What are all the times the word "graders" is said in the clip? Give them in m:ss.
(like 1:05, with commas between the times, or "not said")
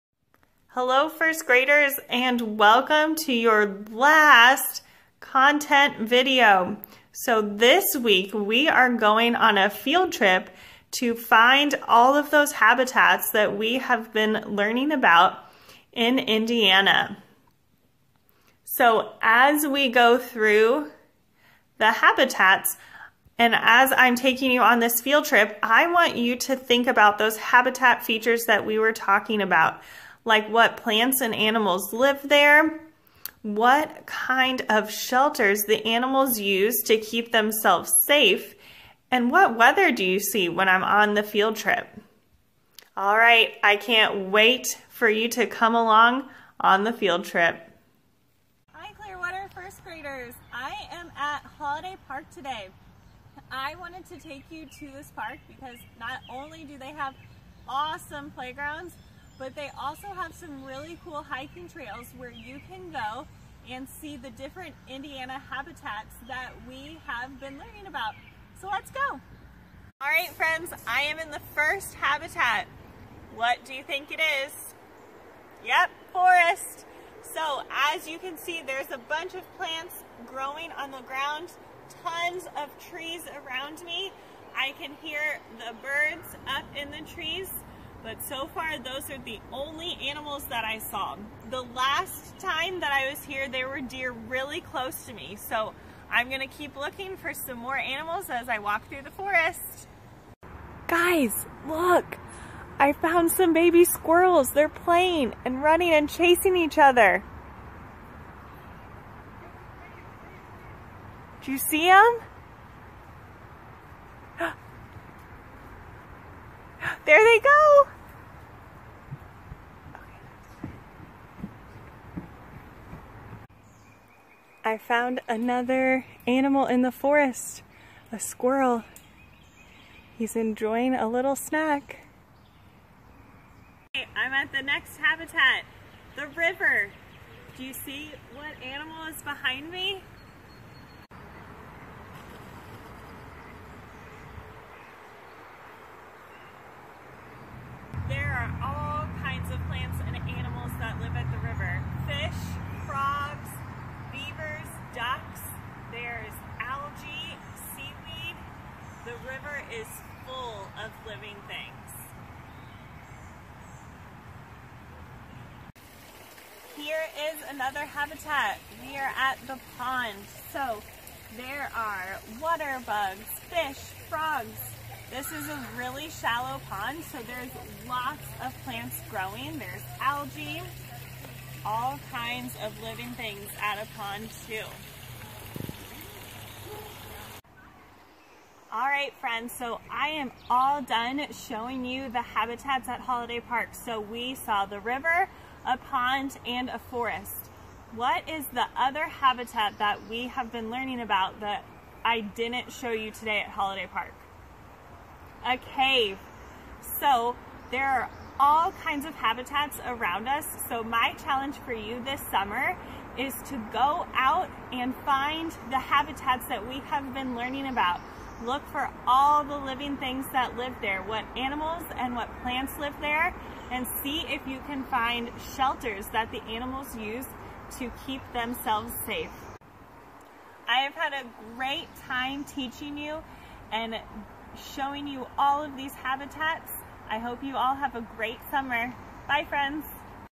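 0:01, 0:49.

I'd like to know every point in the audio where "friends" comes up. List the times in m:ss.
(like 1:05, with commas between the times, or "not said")
1:10, 3:09, 3:59.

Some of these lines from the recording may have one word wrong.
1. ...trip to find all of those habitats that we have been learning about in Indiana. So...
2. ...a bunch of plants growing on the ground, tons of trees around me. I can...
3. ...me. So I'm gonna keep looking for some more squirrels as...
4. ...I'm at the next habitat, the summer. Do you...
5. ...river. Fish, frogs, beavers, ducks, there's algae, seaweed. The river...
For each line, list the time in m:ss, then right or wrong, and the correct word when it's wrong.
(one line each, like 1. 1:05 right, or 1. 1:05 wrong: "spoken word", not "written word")
1. 0:10 right
2. 1:18 right
3. 1:35 wrong: "animals", not "squirrels"
4. 2:14 wrong: "river", not "summer"
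5. 2:31 right.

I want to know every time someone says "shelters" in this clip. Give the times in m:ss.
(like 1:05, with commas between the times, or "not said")
0:34, 3:45.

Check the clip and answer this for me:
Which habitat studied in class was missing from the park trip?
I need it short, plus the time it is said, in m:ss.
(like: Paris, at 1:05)
a cave, at 3:25.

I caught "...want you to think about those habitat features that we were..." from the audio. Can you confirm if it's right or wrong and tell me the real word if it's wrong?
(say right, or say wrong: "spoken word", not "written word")
right.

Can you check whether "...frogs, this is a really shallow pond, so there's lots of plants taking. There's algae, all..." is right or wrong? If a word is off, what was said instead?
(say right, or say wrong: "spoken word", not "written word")
wrong: "growing", not "taking".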